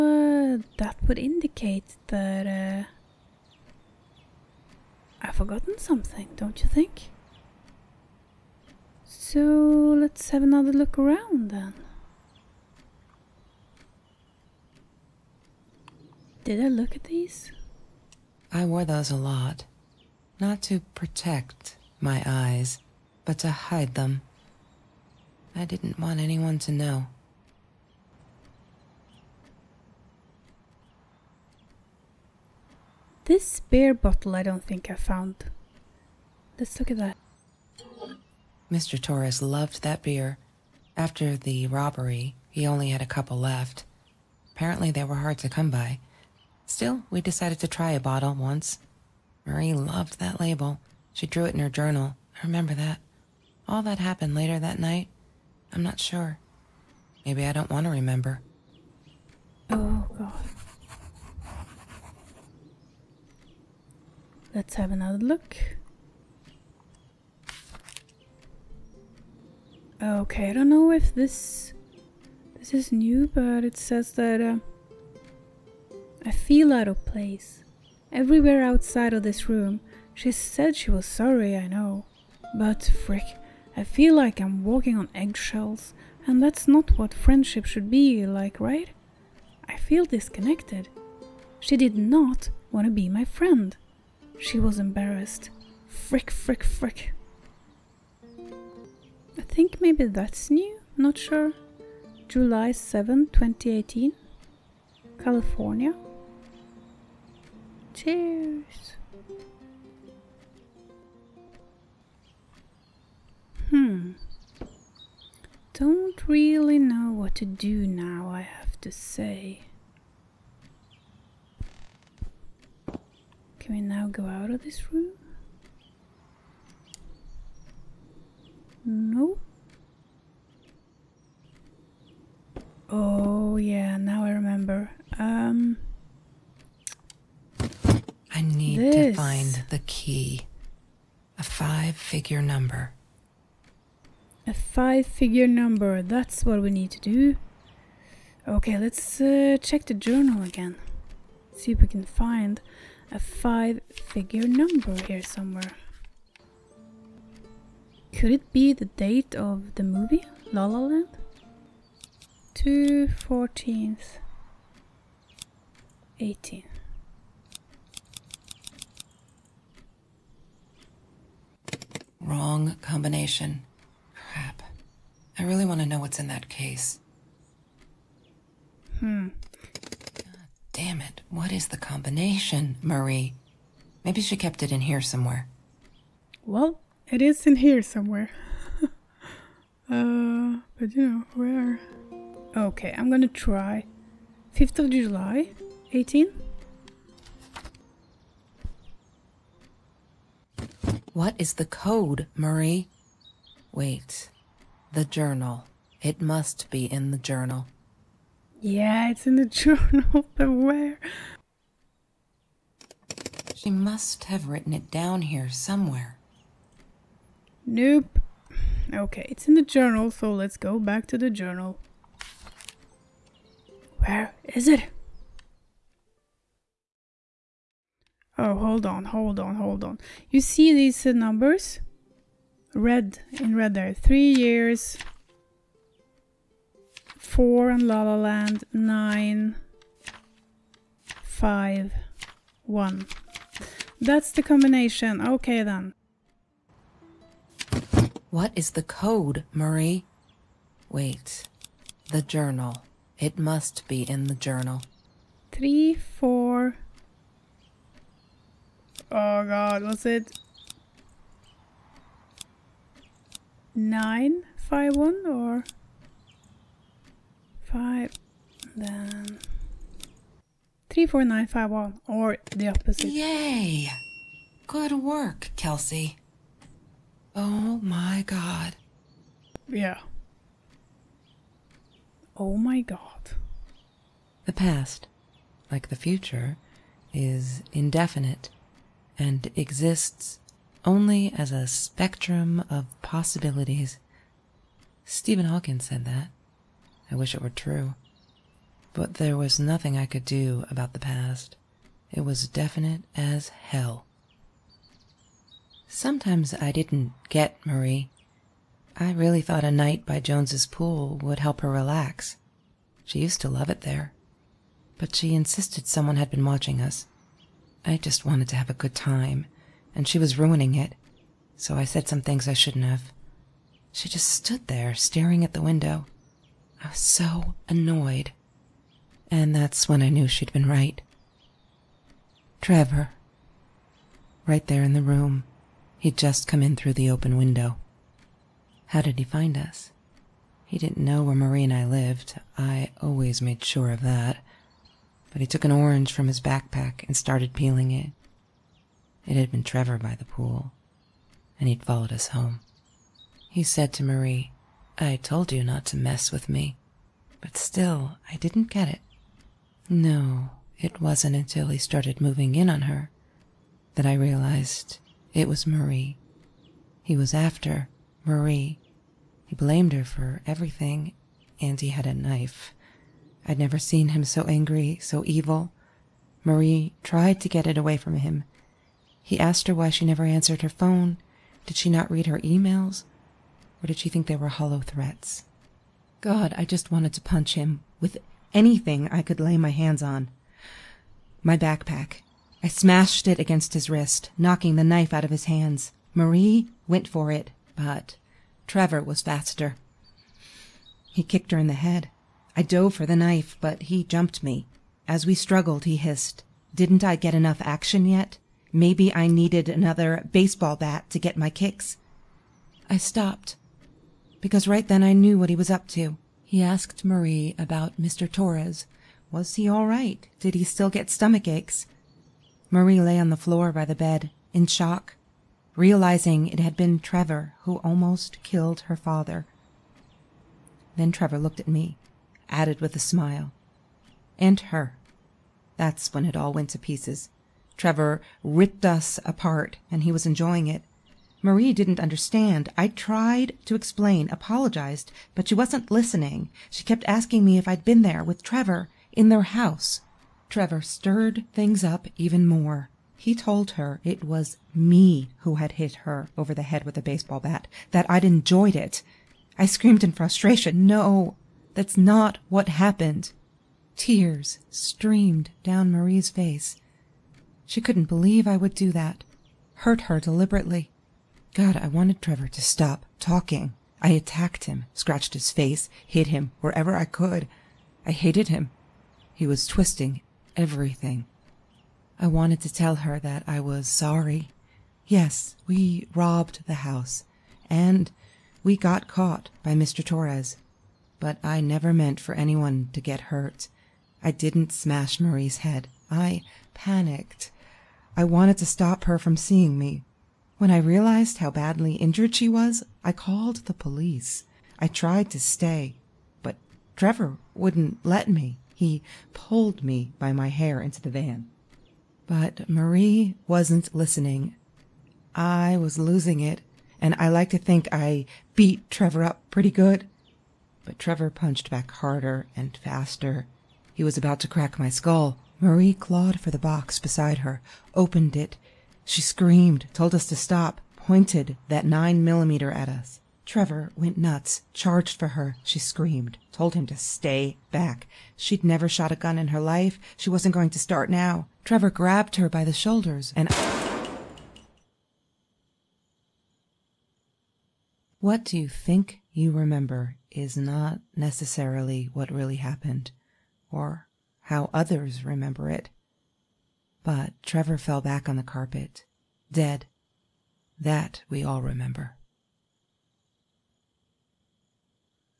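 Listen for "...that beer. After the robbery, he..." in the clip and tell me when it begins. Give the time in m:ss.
0:39.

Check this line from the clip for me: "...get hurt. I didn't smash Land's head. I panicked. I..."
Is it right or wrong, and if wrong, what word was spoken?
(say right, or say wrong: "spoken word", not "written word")
wrong: "Marie", not "Land".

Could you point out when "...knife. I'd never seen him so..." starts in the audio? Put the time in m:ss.
6:12.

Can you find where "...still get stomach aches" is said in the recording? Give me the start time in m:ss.
7:00.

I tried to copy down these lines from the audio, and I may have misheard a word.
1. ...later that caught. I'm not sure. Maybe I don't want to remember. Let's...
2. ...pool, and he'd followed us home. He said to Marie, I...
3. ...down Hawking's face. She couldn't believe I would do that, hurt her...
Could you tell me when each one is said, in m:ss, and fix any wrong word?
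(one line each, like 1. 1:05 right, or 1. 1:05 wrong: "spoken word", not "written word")
1. 0:54 wrong: "night", not "caught"
2. 5:50 right
3. 7:45 wrong: "Marie", not "Hawking".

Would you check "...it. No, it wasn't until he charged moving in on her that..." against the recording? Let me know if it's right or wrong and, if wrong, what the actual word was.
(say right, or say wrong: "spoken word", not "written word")
wrong: "started", not "charged".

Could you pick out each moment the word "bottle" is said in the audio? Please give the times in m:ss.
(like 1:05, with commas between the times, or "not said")
0:33, 0:47.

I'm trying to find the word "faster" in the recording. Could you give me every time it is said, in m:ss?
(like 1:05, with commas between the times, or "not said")
6:39, 8:42.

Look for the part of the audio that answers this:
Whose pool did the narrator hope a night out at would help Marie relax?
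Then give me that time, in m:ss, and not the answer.
5:10.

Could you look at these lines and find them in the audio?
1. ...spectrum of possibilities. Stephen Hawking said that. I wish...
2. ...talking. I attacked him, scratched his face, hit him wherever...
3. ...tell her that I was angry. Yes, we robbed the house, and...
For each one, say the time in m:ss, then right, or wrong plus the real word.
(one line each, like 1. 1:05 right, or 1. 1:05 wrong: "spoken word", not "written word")
1. 4:51 right
2. 7:53 right
3. 8:02 wrong: "sorry", not "angry".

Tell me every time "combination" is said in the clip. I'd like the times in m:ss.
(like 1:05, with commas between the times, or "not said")
2:52, 3:01, 4:04.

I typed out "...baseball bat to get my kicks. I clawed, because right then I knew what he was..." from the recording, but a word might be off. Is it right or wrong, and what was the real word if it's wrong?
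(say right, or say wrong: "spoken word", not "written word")
wrong: "stopped", not "clawed".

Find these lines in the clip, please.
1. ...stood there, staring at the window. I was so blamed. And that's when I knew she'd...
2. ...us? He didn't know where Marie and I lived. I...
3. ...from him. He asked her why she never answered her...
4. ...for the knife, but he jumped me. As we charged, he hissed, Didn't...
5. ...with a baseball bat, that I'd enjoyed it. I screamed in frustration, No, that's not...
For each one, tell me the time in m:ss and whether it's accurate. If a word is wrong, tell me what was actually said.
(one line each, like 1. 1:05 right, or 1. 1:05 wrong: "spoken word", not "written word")
1. 5:24 wrong: "annoyed", not "blamed"
2. 5:39 right
3. 6:17 right
4. 6:42 wrong: "struggled", not "charged"
5. 7:36 right.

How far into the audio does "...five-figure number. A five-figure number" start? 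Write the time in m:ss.
2:21.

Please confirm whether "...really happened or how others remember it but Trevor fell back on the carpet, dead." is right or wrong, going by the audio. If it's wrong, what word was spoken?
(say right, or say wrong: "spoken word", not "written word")
right.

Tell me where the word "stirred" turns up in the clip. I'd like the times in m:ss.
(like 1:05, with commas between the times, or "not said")
7:30.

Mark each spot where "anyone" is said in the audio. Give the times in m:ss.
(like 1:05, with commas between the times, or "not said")
0:26, 8:12.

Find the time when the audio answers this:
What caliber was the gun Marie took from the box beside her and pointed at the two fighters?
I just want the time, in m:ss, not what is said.
8:51.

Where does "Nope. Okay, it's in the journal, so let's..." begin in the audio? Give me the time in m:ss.
3:37.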